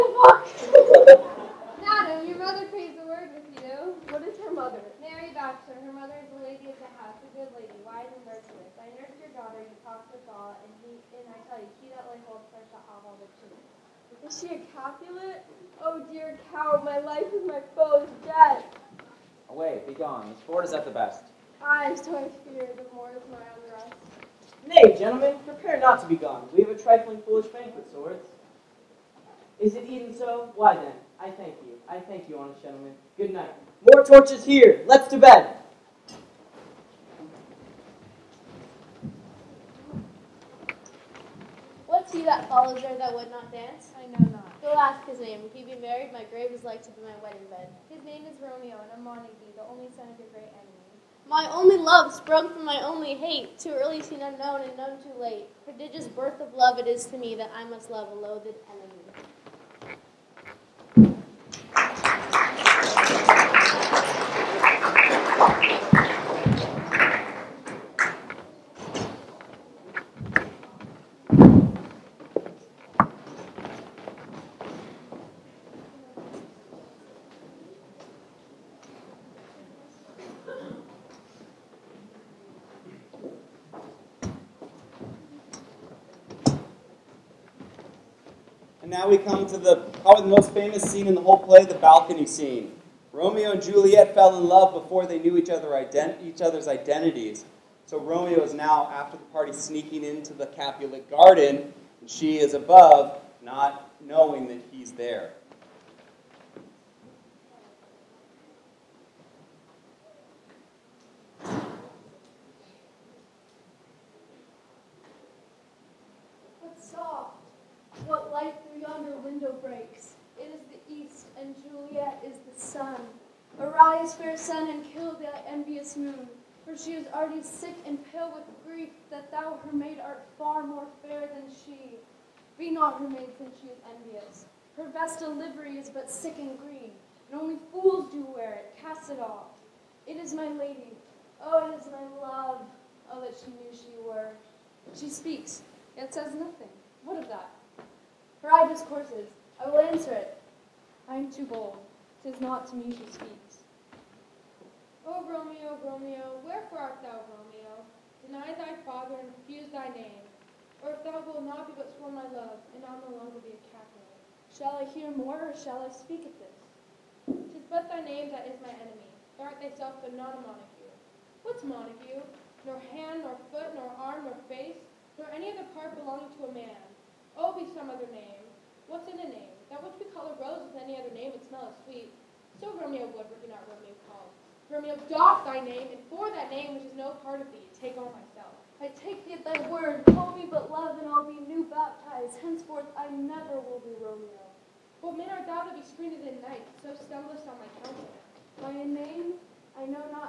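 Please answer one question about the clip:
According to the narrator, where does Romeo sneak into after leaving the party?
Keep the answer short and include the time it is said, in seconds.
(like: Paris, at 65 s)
The Capulet garden, at 100 s.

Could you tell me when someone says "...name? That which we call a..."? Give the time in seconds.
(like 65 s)
179 s.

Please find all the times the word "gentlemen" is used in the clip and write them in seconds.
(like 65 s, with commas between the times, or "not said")
24 s, 32 s.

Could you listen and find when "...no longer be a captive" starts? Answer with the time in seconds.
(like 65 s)
163 s.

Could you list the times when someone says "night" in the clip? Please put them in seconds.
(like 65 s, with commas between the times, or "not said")
33 s, 196 s.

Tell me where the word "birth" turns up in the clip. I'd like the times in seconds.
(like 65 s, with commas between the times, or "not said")
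56 s.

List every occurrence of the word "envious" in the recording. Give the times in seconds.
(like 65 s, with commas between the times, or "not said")
125 s, 133 s.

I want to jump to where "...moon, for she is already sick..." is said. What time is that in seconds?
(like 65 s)
125 s.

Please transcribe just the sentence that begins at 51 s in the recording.
My only love sprung from my only hate, too early seen unknown and known too late.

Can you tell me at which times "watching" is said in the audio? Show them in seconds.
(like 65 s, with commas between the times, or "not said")
not said.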